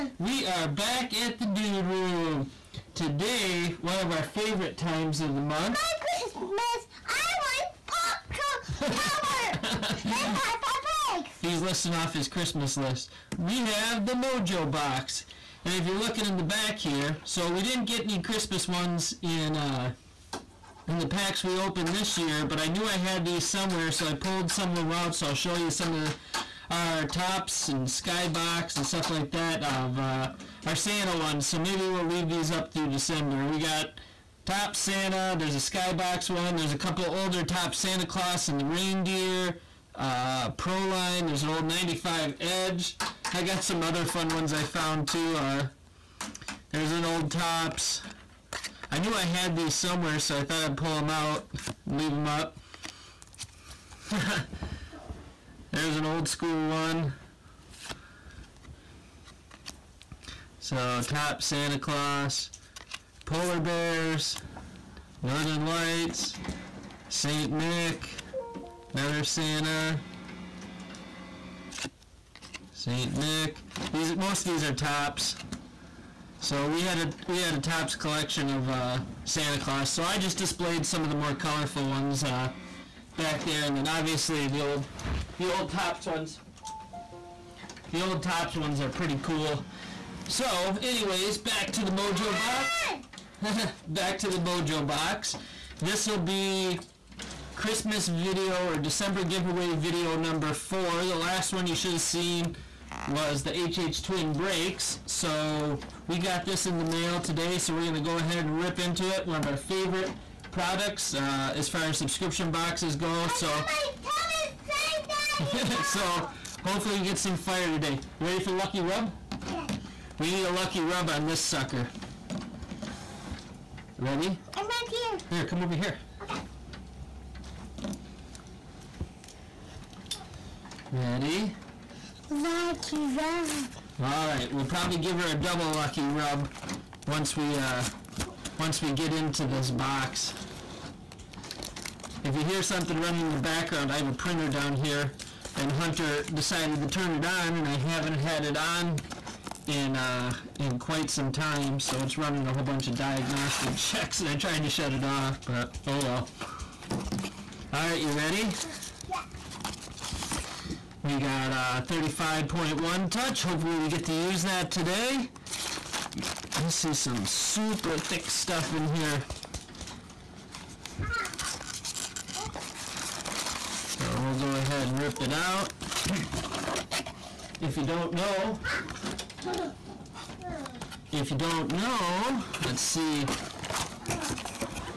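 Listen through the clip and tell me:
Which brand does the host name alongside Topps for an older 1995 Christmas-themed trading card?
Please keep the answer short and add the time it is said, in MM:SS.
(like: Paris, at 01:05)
Edge, at 00:41.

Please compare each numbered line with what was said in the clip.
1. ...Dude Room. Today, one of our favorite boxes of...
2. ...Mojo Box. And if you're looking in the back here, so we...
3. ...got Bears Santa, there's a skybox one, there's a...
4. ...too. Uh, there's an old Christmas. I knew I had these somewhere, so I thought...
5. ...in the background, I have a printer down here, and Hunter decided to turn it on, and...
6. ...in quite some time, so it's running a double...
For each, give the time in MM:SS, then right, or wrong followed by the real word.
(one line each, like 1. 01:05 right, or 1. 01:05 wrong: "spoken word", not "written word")
1. 00:01 wrong: "times", not "boxes"
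2. 00:14 right
3. 00:33 wrong: "Top", not "Bears"
4. 00:45 wrong: "Topps", not "Christmas"
5. 02:23 right
6. 02:30 wrong: "whole", not "double".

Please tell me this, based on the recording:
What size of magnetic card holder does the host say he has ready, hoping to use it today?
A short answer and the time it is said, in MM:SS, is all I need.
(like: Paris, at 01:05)
35.1 touch, at 02:41.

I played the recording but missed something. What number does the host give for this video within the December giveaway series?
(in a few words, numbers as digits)
4.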